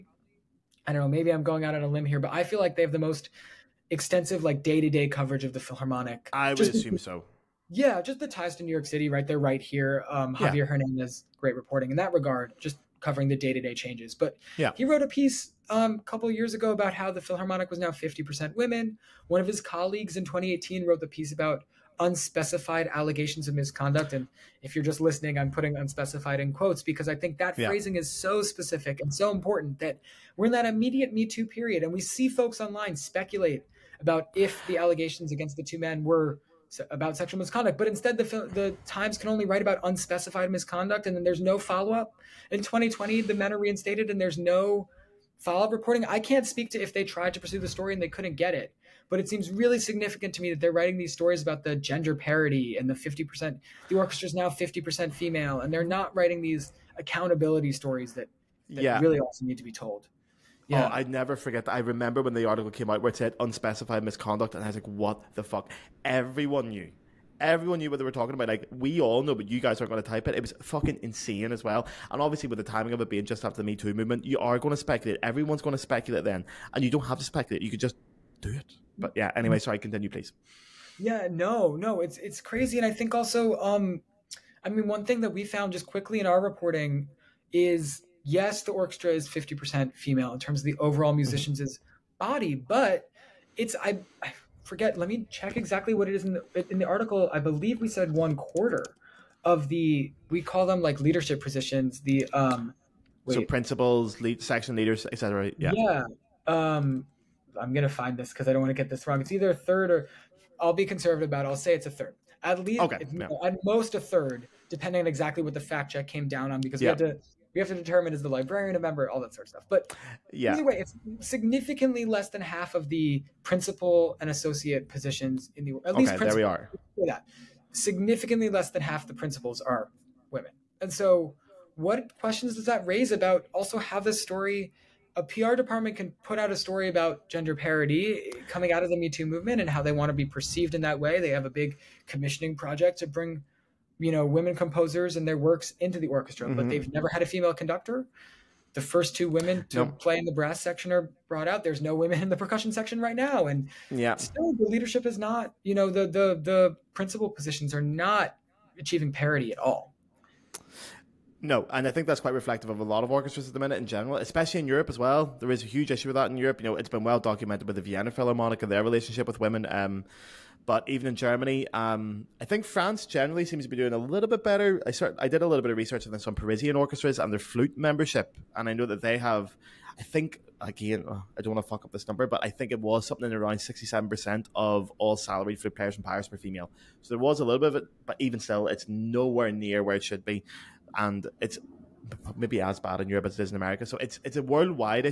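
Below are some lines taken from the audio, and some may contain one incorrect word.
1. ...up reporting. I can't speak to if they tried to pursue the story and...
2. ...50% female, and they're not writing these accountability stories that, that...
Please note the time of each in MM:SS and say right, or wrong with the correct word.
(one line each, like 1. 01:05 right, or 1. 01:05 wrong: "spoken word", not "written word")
1. 00:45 right
2. 00:54 right.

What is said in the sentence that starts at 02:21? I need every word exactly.
They have a big commissioning project to bring you know women composers and their works into the orchestra, mm-hmm.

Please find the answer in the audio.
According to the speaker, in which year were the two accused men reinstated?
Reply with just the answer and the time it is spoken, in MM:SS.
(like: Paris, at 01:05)
2020, at 00:42.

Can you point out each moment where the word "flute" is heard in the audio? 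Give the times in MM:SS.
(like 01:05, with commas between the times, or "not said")
02:57, 03:05.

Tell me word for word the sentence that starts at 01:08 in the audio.
Like, we all know, but you guys aren't going to type it.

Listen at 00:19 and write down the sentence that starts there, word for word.
One of his colleagues in 2018 wrote the piece about unspecified allegations of misconduct.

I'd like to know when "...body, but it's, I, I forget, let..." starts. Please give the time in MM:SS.
01:32.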